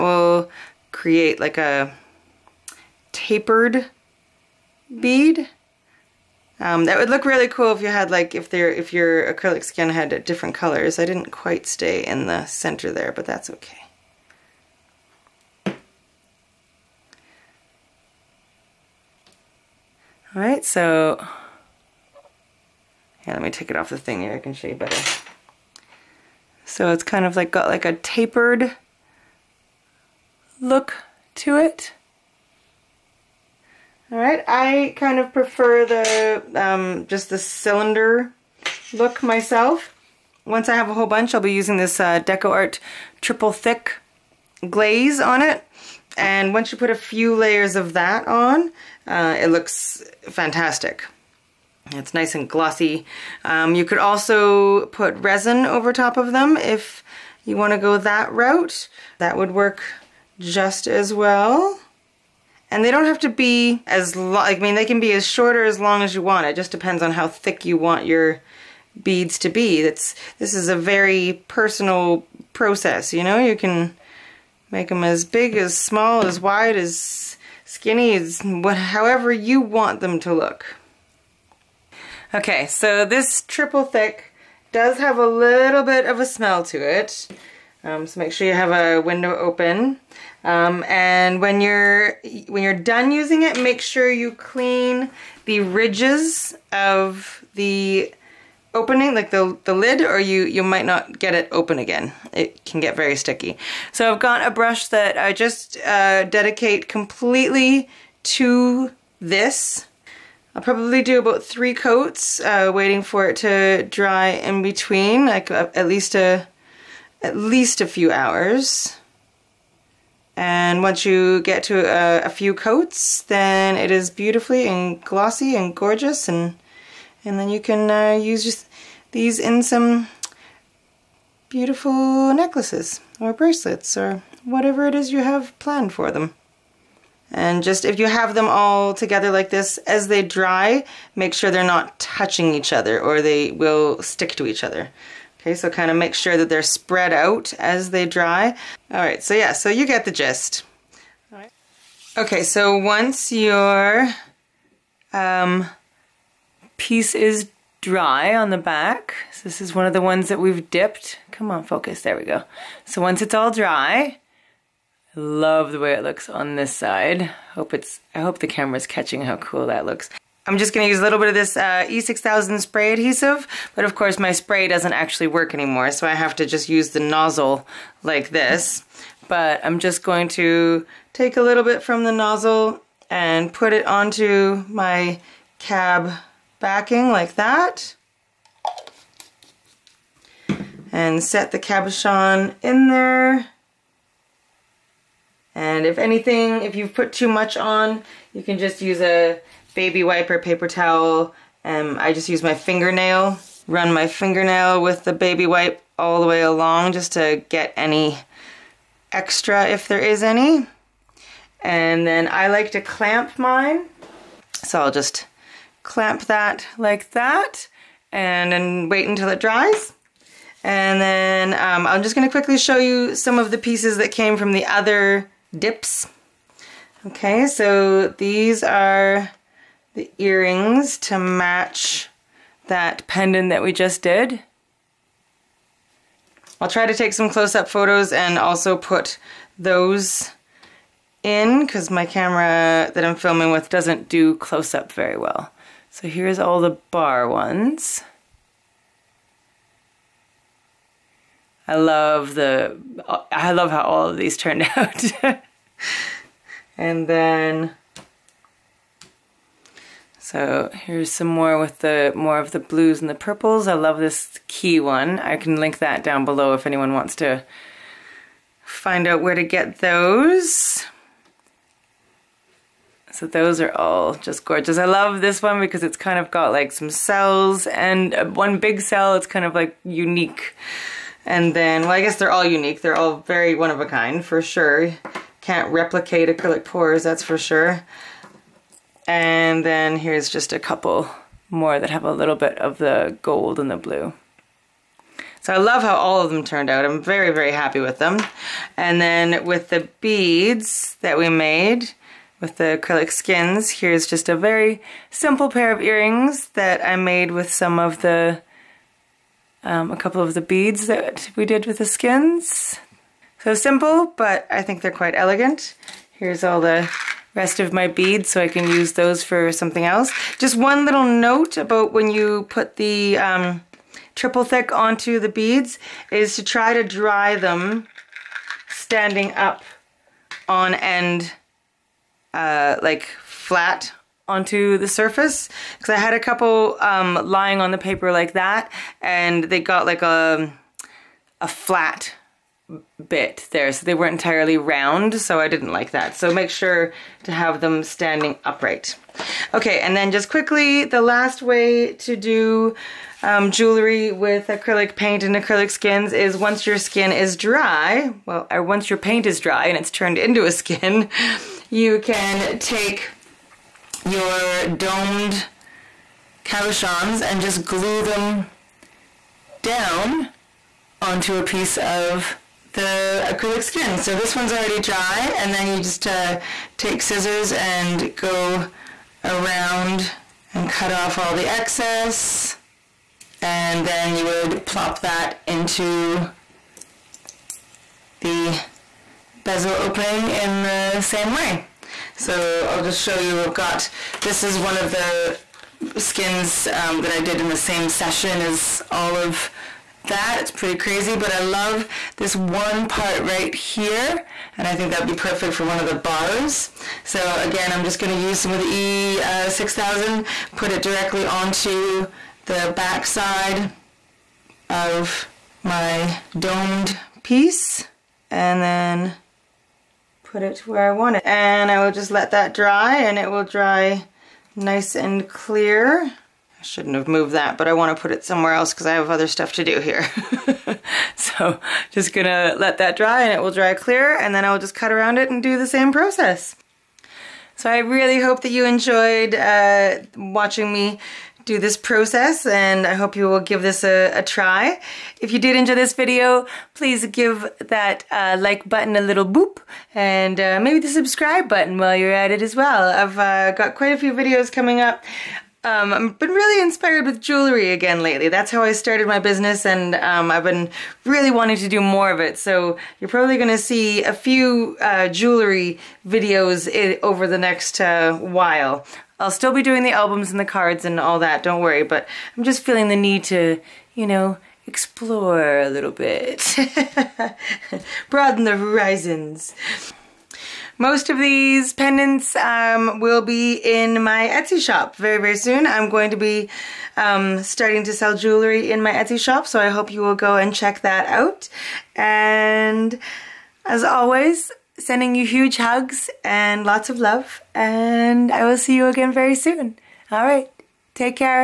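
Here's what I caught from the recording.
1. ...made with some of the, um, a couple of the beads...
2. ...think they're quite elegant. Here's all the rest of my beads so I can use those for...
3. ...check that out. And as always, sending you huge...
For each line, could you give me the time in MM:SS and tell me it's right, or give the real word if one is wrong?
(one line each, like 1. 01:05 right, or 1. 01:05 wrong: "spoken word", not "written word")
1. 05:06 right
2. 05:14 right
3. 08:10 right.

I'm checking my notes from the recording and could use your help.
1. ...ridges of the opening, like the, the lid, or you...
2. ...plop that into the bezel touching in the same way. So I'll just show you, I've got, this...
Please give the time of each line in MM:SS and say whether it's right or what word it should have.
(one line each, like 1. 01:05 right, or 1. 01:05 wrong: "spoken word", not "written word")
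1. 01:35 right
2. 06:24 wrong: "opening", not "touching".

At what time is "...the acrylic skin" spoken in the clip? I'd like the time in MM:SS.
06:12.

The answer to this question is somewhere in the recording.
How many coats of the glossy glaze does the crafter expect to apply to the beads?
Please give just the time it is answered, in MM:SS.
01:51.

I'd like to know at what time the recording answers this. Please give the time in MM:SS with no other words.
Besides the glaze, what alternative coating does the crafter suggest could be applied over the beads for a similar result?
00:55.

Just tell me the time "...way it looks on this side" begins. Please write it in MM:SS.
02:45.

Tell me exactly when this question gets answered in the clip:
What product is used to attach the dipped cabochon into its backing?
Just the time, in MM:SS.
02:51.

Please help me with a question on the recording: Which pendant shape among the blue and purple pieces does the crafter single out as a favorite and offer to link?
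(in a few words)
Key.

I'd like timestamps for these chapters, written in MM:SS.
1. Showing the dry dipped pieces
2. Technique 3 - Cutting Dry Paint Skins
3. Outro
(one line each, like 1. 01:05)
1. 02:30
2. 05:48
3. 07:16.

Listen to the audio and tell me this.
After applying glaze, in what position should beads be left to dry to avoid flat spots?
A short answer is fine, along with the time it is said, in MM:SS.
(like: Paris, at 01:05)
Standing upright, at 05:47.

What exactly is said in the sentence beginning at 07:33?
I've uh, got quite a few videos coming up um, I've been really inspired with jewelry again lately.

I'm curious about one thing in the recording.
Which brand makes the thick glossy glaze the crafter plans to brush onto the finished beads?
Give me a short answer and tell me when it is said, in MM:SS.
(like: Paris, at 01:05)
DecoArt, at 00:42.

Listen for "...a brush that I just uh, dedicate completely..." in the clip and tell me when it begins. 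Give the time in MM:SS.
01:44.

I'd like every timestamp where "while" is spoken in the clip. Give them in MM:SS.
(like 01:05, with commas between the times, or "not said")
07:31, 07:48.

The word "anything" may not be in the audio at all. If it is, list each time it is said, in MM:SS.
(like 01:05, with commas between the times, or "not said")
03:15.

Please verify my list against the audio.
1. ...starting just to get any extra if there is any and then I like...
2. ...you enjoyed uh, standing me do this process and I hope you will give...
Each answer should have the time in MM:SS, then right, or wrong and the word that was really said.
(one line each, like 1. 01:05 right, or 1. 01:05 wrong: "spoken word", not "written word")
1. 03:26 wrong: "along", not "starting"
2. 07:18 wrong: "watching", not "standing".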